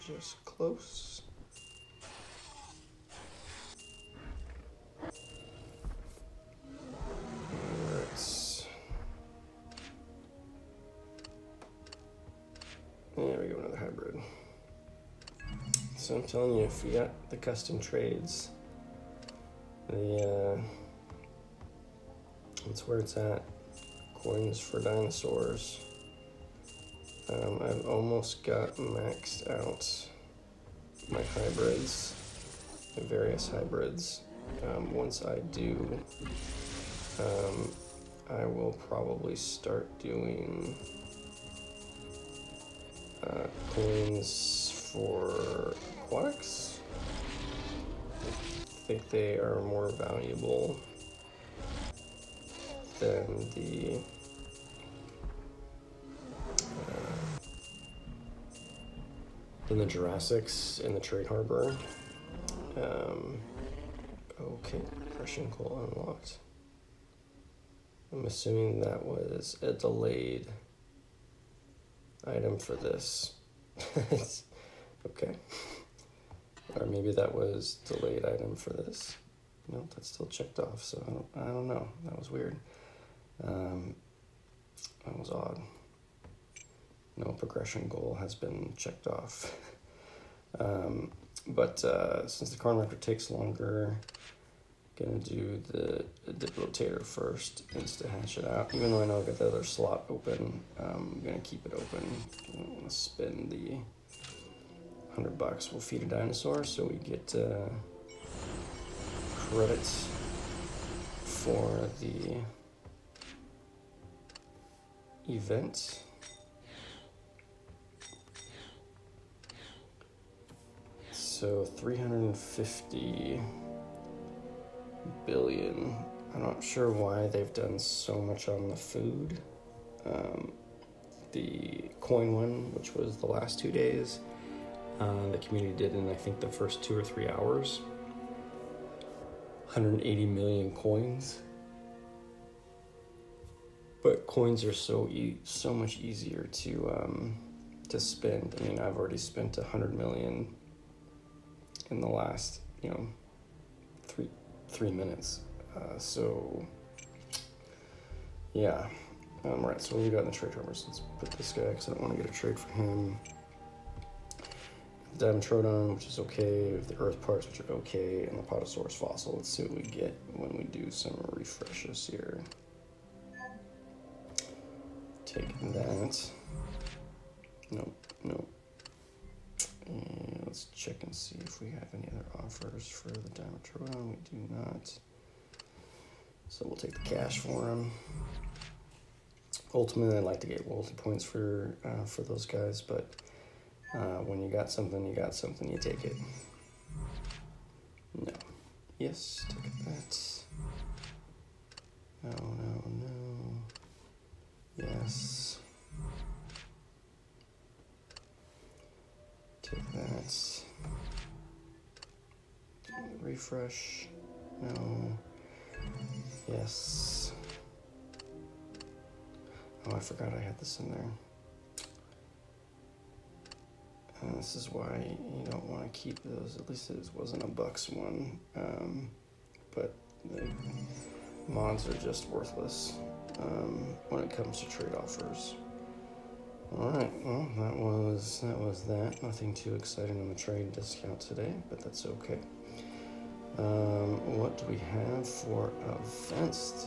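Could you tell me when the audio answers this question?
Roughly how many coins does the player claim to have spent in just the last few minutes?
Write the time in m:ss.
2:29.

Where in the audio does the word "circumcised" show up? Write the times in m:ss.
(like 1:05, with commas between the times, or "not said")
not said.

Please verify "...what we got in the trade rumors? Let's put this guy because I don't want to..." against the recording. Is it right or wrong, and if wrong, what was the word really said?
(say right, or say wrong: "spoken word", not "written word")
right.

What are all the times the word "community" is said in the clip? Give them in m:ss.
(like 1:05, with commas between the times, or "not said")
2:15.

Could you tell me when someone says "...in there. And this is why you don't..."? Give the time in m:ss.
3:40.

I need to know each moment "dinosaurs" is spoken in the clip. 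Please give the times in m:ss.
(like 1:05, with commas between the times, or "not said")
0:24, 1:46.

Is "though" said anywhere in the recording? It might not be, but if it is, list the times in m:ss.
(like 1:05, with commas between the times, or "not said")
1:38.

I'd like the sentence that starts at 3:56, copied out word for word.
All right, well that was that was that.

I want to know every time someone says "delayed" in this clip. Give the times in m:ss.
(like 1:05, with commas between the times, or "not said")
1:09, 1:17.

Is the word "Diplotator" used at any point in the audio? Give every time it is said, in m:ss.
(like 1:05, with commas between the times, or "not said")
1:36.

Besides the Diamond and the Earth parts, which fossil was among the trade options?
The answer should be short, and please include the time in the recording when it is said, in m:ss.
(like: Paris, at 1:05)
Potosaurus fossil, at 2:48.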